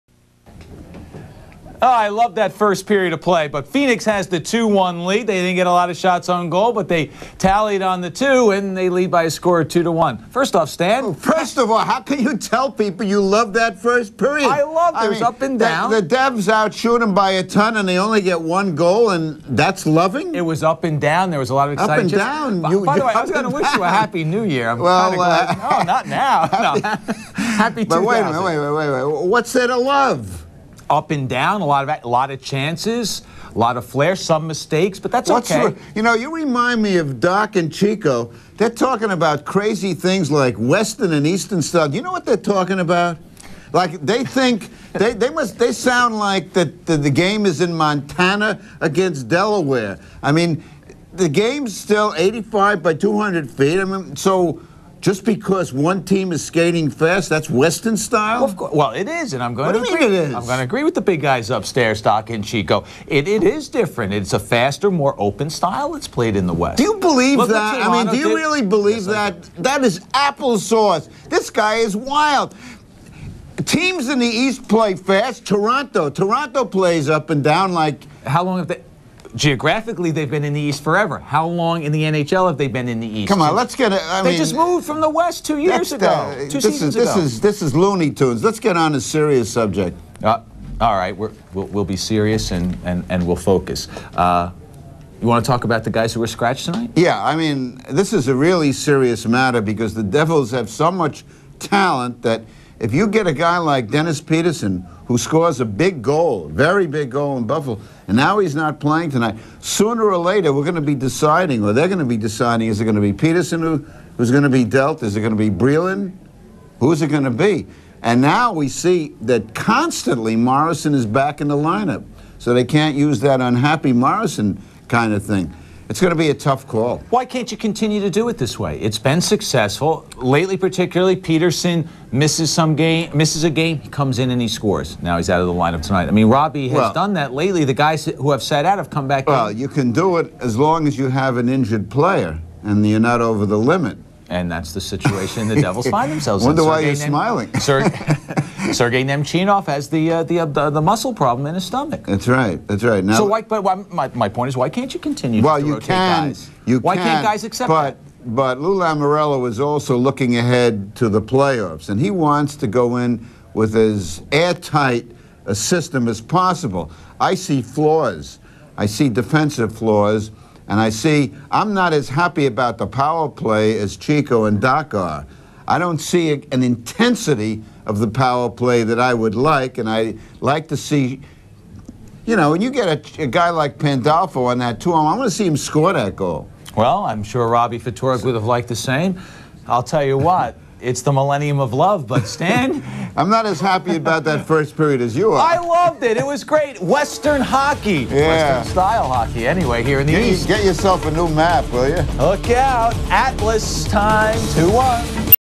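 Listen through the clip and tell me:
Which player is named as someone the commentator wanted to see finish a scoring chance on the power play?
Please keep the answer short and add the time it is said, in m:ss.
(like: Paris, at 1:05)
Pandolfo, at 3:03.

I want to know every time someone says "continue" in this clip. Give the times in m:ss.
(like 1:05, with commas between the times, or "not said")
2:07, 2:34.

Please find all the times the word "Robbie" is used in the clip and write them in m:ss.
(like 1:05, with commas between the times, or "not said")
2:16, 3:07.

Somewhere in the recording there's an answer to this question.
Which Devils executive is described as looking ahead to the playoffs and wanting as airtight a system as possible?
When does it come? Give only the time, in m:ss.
2:38.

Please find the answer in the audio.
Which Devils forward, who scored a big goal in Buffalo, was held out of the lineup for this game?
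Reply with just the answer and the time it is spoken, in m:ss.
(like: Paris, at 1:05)
Denis Pederson, at 1:43.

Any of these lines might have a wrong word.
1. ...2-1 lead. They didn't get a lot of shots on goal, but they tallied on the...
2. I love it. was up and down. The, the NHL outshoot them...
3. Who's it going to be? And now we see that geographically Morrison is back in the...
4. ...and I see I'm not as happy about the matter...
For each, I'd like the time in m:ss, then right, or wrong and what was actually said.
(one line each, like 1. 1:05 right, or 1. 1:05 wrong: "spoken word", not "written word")
1. 0:04 right
2. 0:14 wrong: "Devs", not "NHL"
3. 1:56 wrong: "constantly", not "geographically"
4. 2:50 wrong: "power", not "matter".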